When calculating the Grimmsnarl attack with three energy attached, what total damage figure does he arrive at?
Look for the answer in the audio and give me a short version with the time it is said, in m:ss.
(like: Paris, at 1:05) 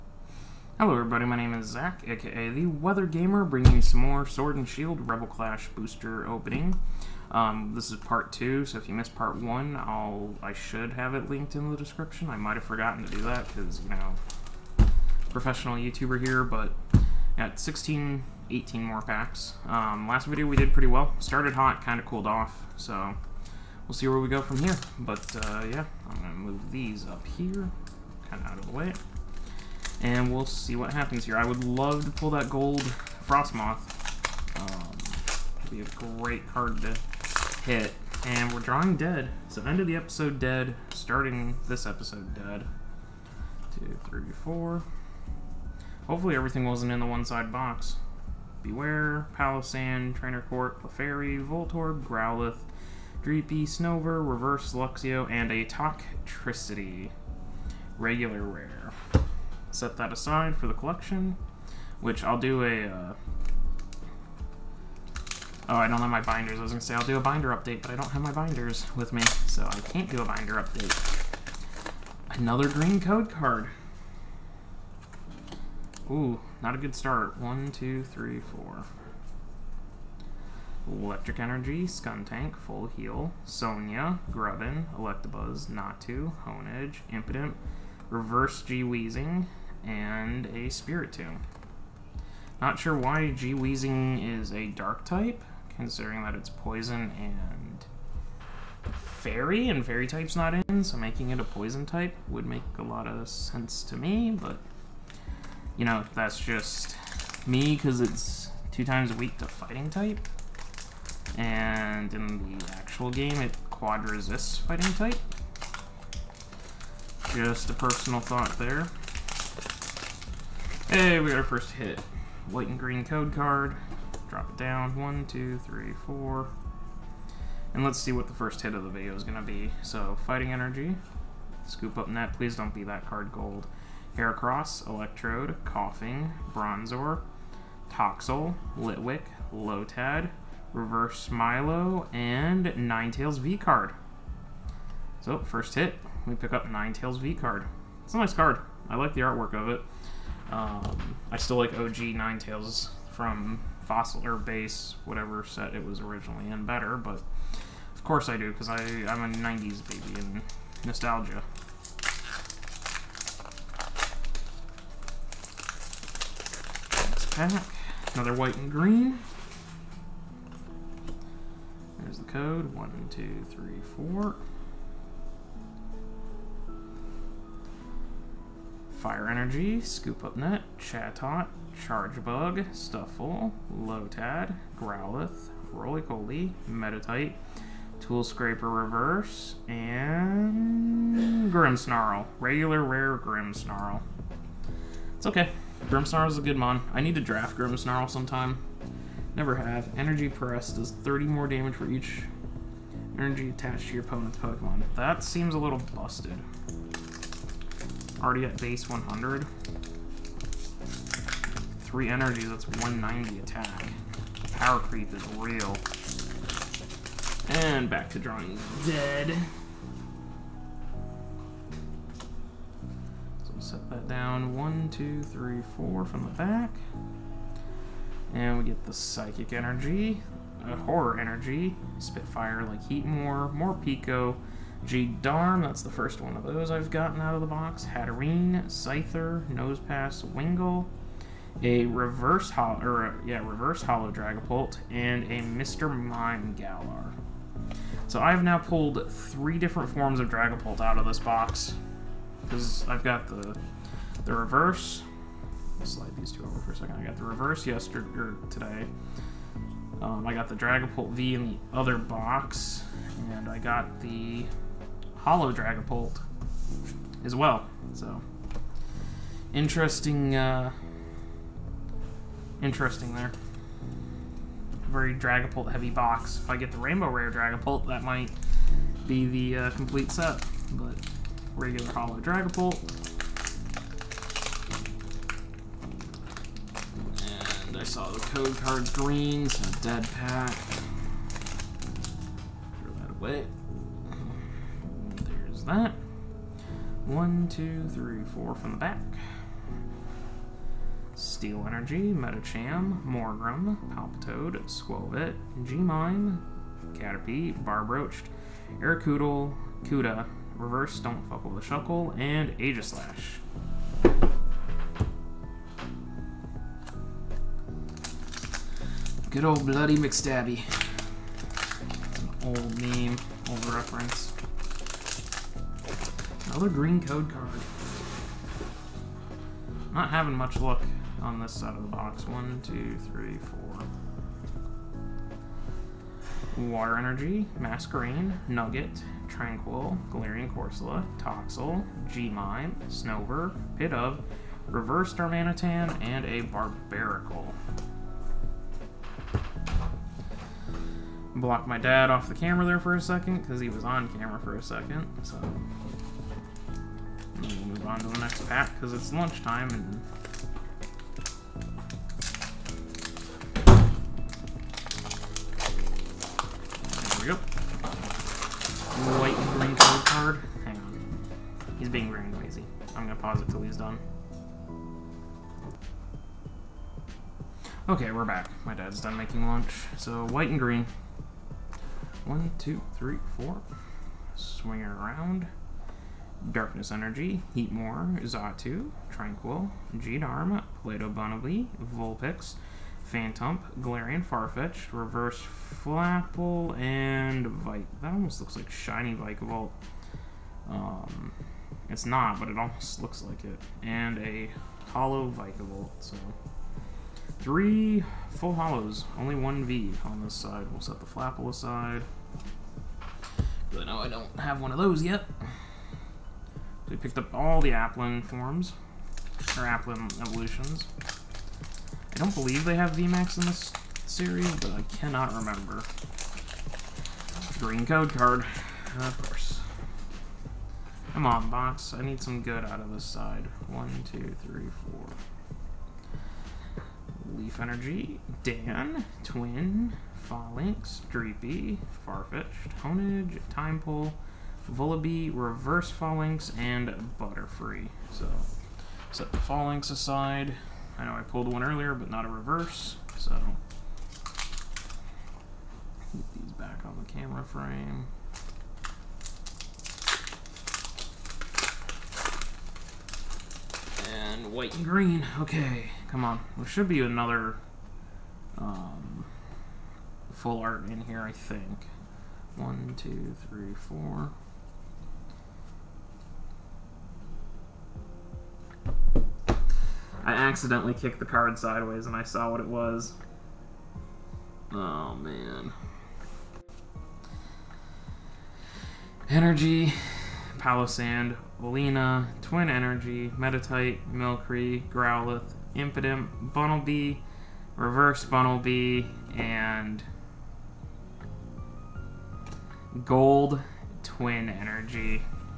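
190, at 3:32.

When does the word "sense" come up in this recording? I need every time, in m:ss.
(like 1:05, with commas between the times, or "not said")
1:43.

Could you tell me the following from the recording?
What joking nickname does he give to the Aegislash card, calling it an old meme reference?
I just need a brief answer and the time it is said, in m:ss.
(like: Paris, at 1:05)
Bloody McStabby, at 5:19.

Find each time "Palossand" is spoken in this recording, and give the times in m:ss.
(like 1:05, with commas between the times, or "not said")
0:49, 8:10.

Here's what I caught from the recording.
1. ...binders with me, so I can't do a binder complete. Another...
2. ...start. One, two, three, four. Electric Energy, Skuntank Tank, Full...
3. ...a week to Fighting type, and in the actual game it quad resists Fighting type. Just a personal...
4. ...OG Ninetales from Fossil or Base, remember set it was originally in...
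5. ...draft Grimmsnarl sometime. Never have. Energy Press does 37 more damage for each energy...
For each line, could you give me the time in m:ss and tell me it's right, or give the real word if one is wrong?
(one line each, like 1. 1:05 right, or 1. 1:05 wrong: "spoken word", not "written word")
1. 1:08 wrong: "update", not "complete"
2. 1:16 right
3. 1:49 right
4. 2:31 wrong: "whatever", not "remember"
5. 3:17 wrong: "30", not "37".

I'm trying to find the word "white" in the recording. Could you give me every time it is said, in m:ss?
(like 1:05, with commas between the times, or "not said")
2:02, 2:48, 6:09, 6:20, 7:44.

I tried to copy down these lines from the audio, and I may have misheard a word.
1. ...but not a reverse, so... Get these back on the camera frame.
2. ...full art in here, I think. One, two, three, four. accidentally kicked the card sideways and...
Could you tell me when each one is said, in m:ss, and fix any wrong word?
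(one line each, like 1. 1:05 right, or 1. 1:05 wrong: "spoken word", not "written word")
1. 7:31 right
2. 7:50 right.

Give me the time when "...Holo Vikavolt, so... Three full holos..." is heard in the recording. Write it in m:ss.
6:44.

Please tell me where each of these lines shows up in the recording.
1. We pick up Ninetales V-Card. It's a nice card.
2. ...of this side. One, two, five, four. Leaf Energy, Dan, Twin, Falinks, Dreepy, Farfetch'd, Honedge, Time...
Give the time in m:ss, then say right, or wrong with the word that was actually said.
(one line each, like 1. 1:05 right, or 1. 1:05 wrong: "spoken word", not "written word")
1. 2:26 right
2. 7:12 wrong: "three", not "five".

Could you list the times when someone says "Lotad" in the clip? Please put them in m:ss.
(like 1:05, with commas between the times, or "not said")
2:19, 3:03.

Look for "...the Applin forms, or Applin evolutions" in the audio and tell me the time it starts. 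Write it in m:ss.
6:57.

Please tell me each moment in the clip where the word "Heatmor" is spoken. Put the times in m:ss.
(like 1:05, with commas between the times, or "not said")
3:52, 6:27.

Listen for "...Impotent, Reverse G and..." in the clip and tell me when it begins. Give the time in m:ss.
1:27.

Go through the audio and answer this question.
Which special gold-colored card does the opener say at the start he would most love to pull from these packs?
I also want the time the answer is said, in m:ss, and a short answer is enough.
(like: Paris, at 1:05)
Gold Frosmoth, at 0:32.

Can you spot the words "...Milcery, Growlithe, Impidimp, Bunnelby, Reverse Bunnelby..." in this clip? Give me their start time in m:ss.
8:14.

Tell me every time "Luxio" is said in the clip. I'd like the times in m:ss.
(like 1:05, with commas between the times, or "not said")
0:54.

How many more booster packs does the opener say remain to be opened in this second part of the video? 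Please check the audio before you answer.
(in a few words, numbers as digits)
18.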